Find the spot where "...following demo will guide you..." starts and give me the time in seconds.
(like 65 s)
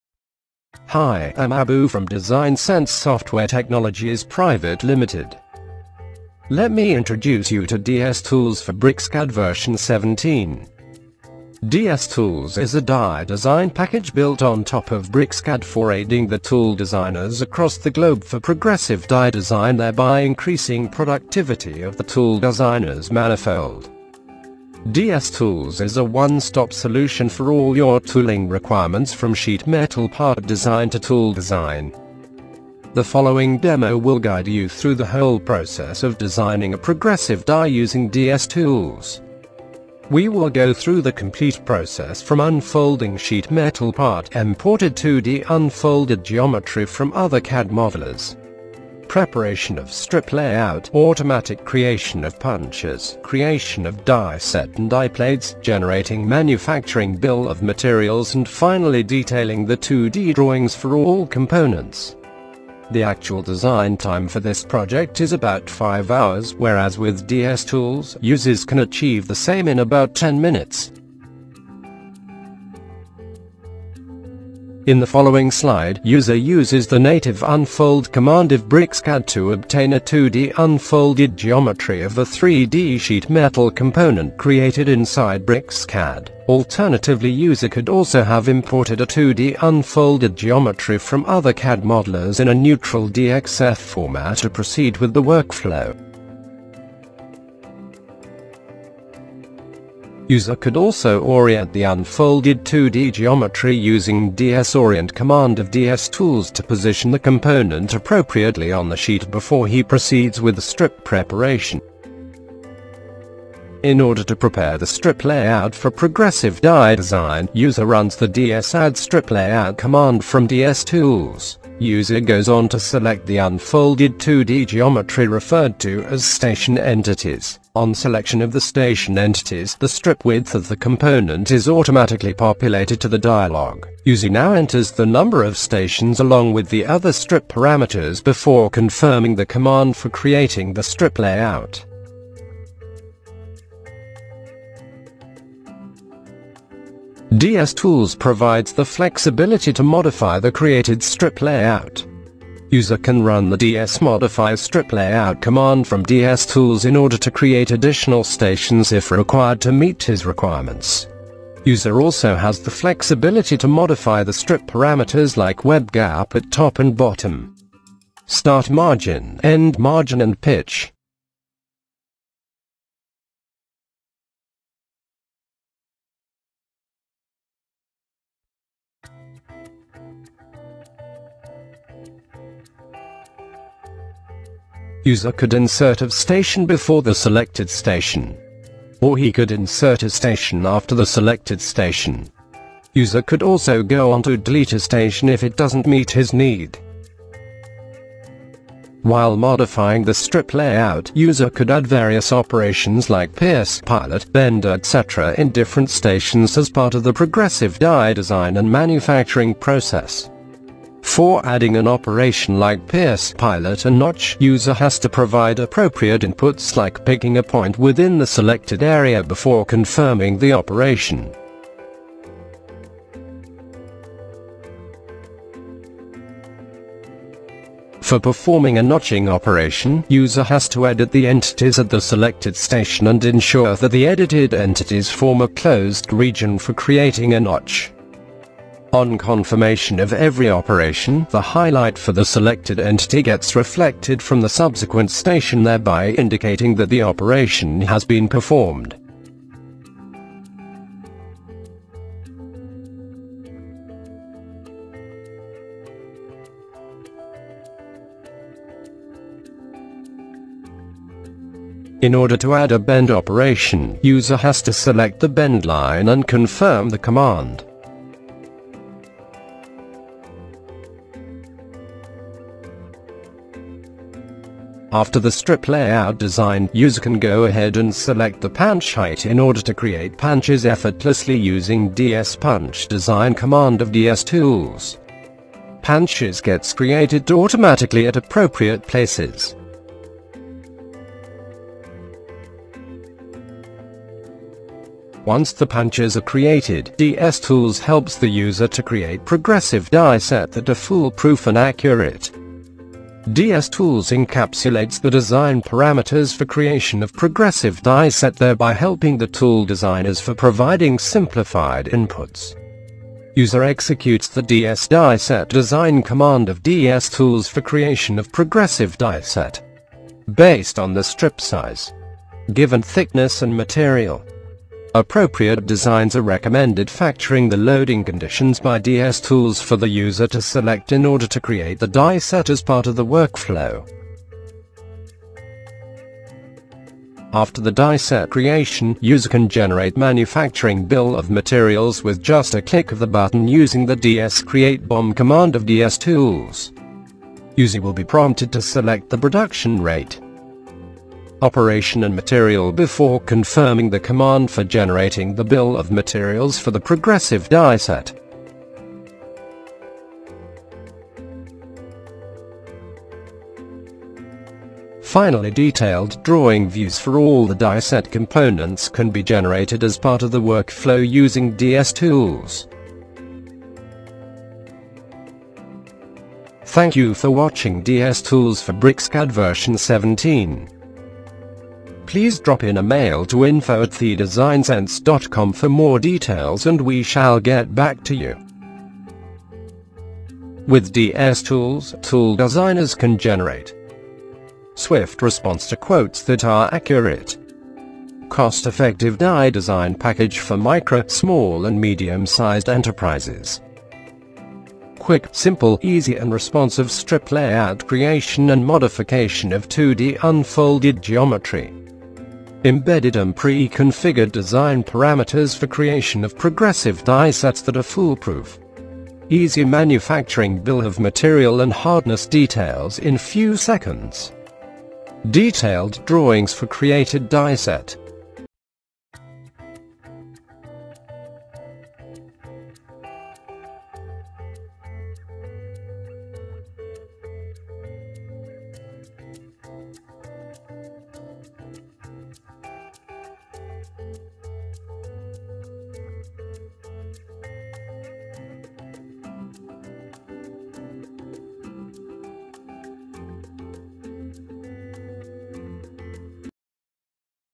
33 s.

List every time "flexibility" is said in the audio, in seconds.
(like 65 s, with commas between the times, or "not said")
148 s, 162 s.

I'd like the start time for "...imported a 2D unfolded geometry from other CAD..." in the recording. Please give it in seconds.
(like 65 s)
88 s.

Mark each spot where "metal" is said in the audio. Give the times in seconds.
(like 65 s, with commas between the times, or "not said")
29 s, 43 s, 83 s.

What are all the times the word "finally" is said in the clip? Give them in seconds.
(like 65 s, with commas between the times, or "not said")
58 s, 365 s.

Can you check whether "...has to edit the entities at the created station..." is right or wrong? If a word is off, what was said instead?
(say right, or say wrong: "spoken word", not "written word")
wrong: "selected", not "created".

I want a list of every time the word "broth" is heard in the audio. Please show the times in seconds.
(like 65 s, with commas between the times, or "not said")
not said.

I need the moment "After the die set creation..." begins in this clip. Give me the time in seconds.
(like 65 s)
337 s.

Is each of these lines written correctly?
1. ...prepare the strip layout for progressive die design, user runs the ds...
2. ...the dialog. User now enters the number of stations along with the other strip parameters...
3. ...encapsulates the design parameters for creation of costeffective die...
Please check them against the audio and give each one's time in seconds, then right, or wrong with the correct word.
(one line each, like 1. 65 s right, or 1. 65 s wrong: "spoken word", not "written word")
1. 114 s right
2. 133 s right
3. 304 s wrong: "progressive", not "costeffective".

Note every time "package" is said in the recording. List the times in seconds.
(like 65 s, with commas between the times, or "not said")
13 s, 399 s.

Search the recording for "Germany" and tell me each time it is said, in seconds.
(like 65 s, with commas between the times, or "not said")
not said.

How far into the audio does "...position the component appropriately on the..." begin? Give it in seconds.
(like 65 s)
106 s.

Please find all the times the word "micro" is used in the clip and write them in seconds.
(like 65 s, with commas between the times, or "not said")
400 s.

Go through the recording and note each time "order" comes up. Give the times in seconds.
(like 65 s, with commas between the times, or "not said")
113 s, 156 s, 262 s, 279 s, 331 s.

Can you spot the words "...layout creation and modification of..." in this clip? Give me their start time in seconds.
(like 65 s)
407 s.